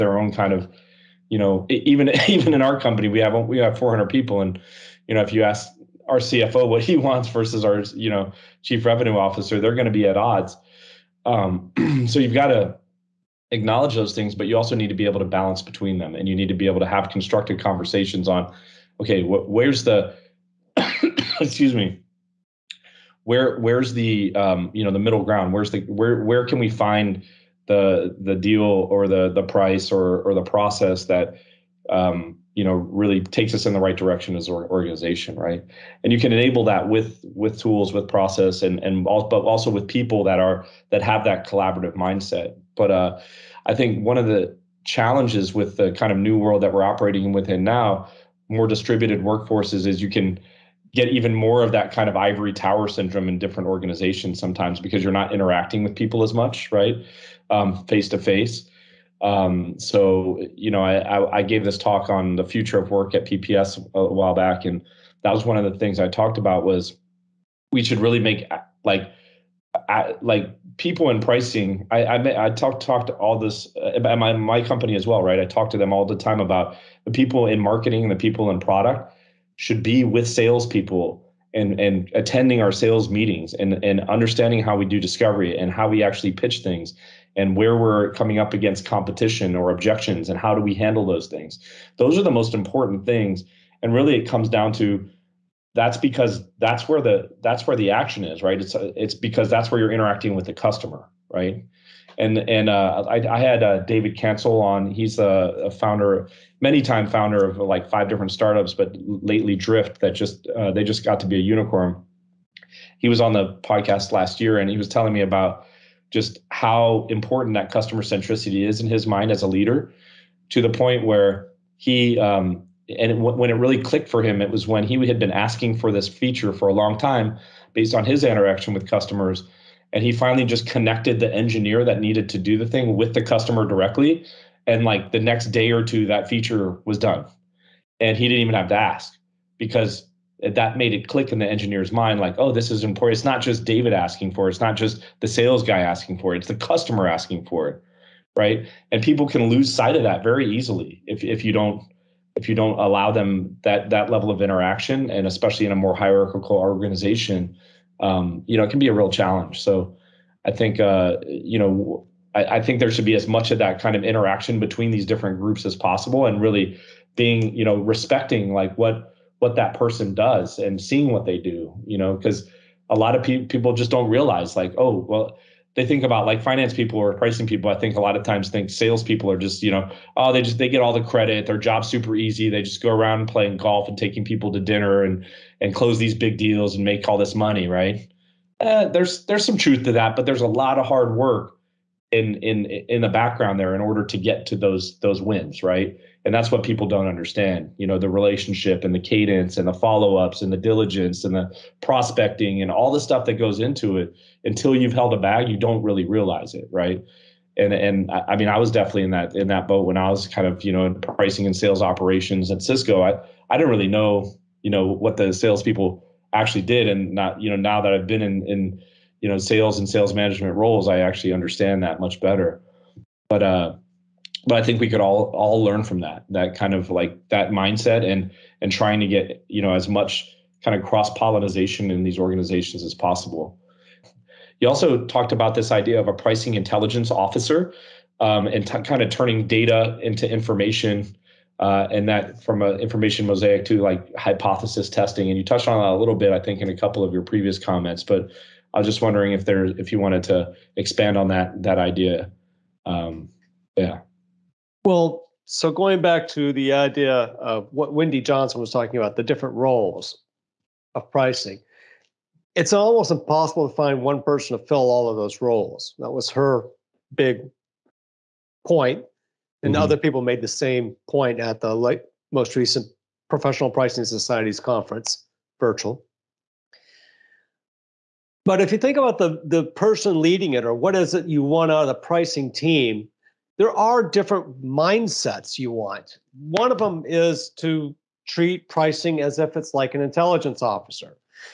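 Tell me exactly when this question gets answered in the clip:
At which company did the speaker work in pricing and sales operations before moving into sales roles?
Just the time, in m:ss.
3:32.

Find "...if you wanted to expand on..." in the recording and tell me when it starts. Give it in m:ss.
4:09.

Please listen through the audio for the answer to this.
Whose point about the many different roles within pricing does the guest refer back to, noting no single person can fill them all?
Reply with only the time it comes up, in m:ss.
4:17.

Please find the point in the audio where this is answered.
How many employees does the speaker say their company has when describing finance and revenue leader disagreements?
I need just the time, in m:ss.
0:03.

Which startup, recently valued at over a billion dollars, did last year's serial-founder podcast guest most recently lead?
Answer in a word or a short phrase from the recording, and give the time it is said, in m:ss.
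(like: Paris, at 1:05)
Drift, at 1:49.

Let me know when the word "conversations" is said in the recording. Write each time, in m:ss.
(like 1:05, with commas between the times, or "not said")
0:17.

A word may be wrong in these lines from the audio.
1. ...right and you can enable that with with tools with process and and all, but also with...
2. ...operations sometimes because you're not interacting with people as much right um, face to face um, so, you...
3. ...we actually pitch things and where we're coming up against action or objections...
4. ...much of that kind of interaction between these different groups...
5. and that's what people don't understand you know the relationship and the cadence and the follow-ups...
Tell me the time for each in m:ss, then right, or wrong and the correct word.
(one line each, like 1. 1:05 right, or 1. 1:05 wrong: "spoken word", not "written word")
1. 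0:35 right
2. 0:53 wrong: "organizations", not "operations"
3. 1:25 wrong: "competition", not "action"
4. 2:43 right
5. 3:16 right.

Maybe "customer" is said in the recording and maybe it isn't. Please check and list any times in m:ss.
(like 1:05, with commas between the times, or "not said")
1:40, 1:57, 2:08, 2:13, 2:26.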